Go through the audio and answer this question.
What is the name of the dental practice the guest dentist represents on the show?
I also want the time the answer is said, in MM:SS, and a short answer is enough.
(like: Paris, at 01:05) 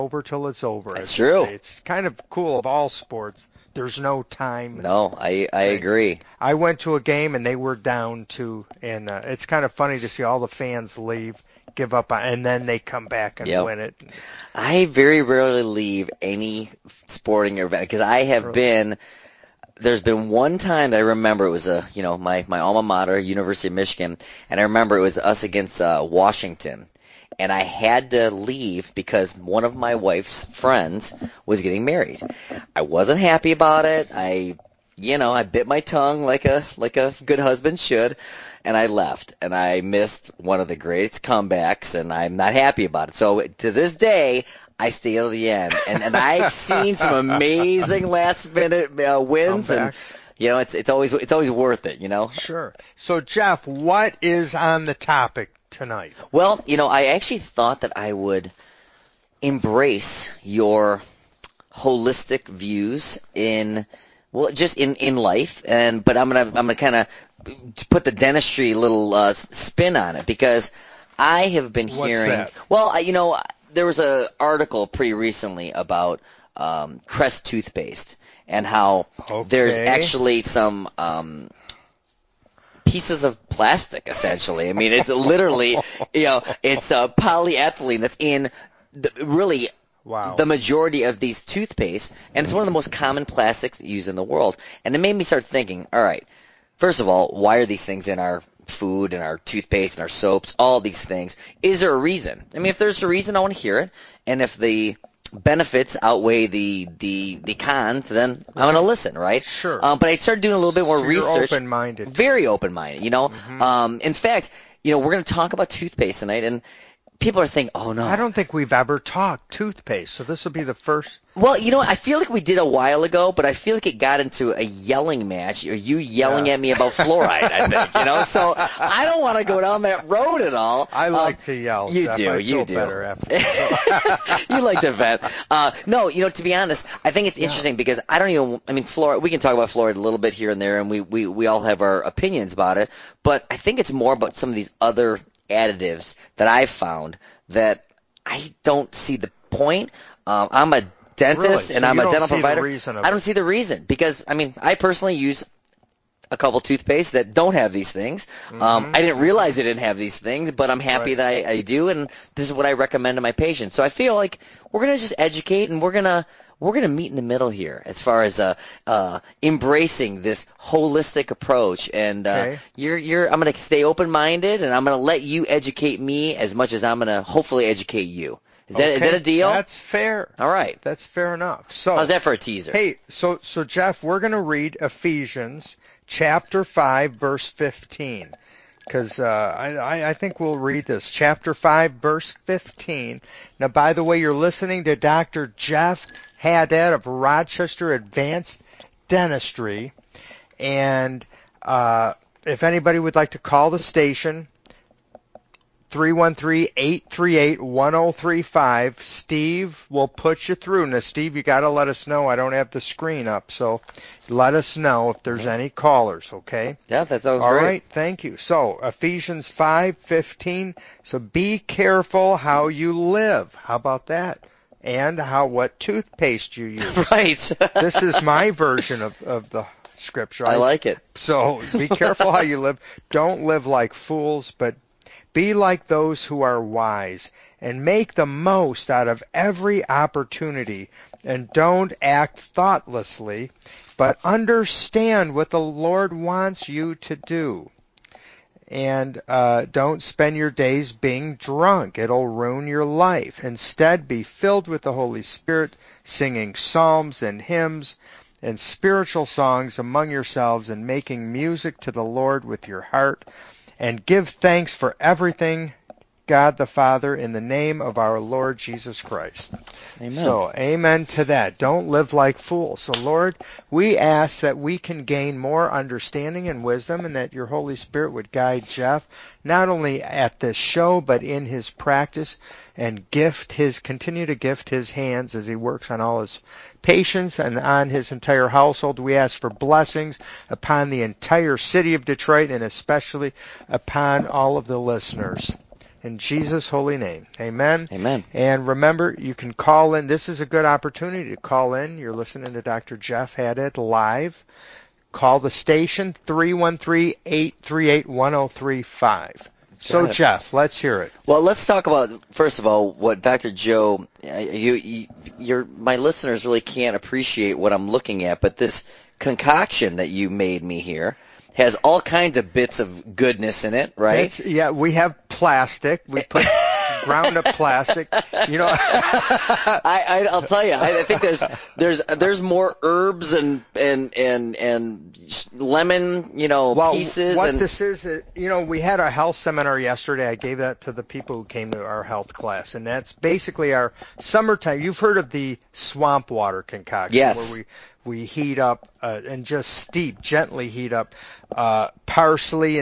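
Rochester Advanced Dentistry, at 03:17.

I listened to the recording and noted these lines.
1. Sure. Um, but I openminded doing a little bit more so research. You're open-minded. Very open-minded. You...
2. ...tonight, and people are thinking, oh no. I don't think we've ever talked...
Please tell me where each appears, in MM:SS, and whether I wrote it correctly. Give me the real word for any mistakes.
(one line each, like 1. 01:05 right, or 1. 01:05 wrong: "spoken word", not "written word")
1. 01:49 wrong: "started", not "openminded"
2. 01:56 right.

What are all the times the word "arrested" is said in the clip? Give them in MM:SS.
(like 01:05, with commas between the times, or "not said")
not said.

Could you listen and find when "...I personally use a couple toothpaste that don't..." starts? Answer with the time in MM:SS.
02:34.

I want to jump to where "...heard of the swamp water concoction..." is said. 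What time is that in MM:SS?
05:44.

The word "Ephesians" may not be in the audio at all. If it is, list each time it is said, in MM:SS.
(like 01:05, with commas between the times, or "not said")
03:04, 03:38.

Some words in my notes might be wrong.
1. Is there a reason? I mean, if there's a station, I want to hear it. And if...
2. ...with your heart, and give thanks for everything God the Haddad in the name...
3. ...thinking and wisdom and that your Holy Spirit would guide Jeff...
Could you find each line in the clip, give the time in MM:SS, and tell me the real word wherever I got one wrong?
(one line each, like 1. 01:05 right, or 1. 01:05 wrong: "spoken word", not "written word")
1. 01:41 wrong: "reason", not "station"
2. 04:22 wrong: "Father", not "Haddad"
3. 04:35 wrong: "understanding", not "thinking".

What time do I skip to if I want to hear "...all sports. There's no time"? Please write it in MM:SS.
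00:02.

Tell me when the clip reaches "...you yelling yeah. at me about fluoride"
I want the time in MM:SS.
02:05.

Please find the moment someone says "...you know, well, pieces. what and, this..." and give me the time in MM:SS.
05:36.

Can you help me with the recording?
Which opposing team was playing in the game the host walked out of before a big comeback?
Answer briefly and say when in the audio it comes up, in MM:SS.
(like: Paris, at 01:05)
Washington, at 00:26.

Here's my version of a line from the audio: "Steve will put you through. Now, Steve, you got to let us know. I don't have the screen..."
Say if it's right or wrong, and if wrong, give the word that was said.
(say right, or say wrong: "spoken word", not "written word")
right.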